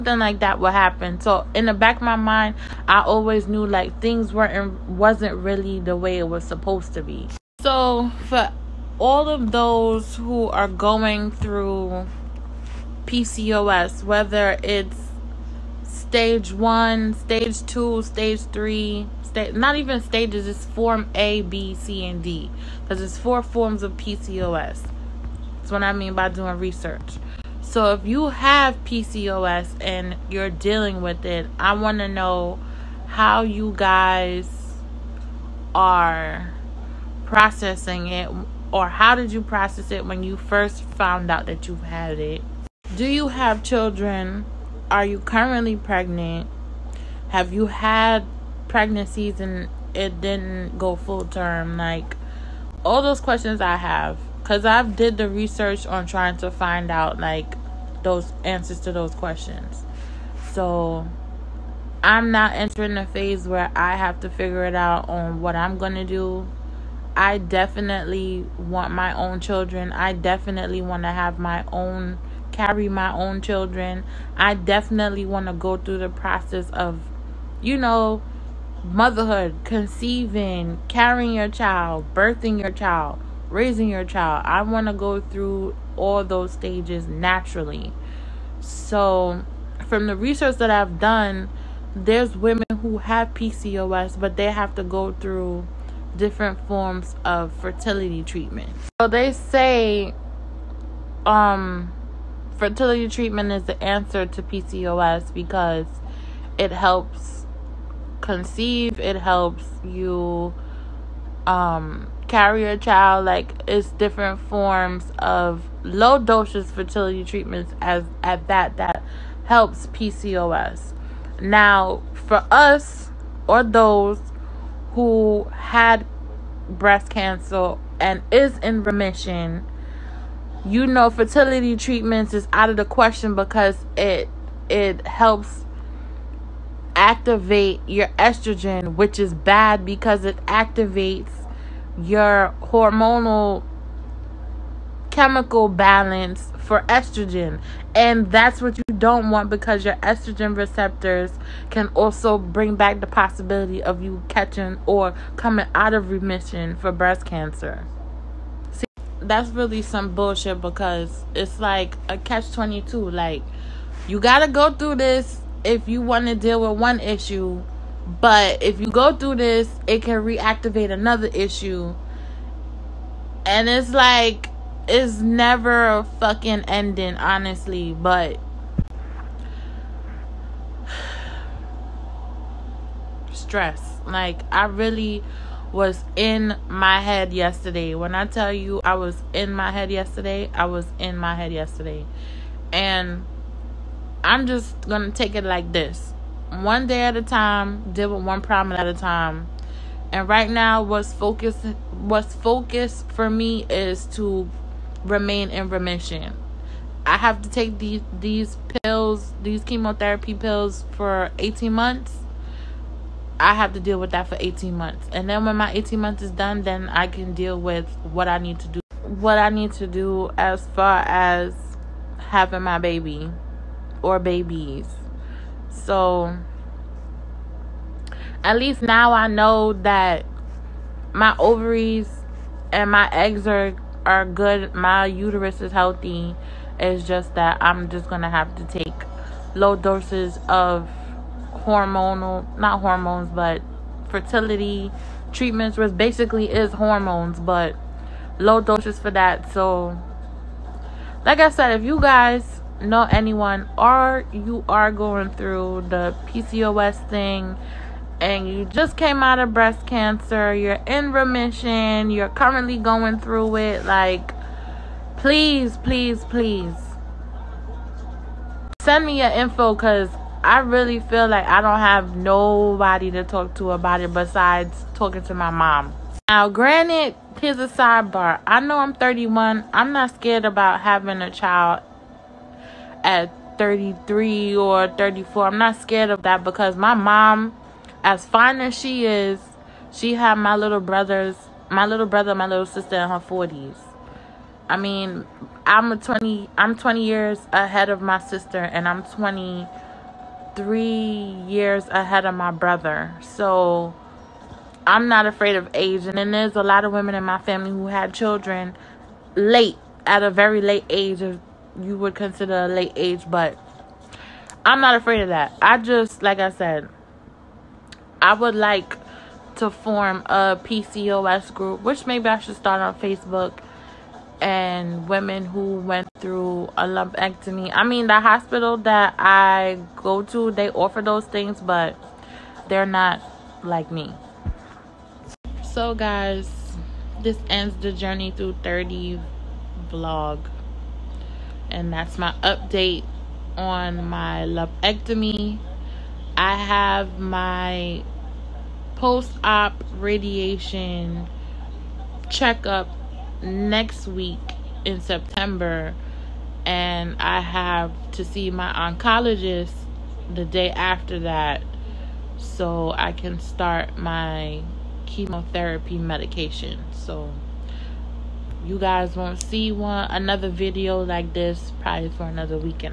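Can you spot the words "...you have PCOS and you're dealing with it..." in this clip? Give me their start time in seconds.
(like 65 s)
28 s.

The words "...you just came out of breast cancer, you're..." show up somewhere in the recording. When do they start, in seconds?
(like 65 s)
258 s.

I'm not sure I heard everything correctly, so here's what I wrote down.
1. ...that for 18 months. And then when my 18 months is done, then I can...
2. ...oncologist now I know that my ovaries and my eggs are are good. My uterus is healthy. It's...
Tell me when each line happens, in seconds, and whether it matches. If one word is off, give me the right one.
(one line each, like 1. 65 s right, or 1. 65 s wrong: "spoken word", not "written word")
1. 214 s right
2. 228 s wrong: "least", not "oncologist".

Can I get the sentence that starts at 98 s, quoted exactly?
So they say um fertility treatment is the answer to PCOS because it helps conceive, it helps you um, carry a child.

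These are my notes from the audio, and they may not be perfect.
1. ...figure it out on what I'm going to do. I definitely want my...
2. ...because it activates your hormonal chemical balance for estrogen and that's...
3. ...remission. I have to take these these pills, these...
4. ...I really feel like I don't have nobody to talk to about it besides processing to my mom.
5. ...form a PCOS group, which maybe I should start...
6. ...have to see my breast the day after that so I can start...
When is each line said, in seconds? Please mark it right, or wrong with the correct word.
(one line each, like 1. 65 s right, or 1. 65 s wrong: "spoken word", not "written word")
1. 64 s right
2. 139 s right
3. 205 s right
4. 270 s wrong: "talking", not "processing"
5. 319 s right
6. 357 s wrong: "oncologist", not "breast".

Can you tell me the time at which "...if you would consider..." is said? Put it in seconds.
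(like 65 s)
311 s.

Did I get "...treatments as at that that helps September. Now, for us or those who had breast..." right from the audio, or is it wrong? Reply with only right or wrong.
wrong.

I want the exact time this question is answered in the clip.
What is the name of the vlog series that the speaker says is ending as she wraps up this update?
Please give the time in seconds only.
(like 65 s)
337 s.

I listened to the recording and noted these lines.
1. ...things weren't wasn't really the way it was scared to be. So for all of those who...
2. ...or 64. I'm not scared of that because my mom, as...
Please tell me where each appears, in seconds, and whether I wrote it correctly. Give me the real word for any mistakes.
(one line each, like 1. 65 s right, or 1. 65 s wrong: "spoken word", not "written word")
1. 3 s wrong: "supposed", not "scared"
2. 284 s wrong: "34", not "64".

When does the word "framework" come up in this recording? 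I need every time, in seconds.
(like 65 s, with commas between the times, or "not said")
not said.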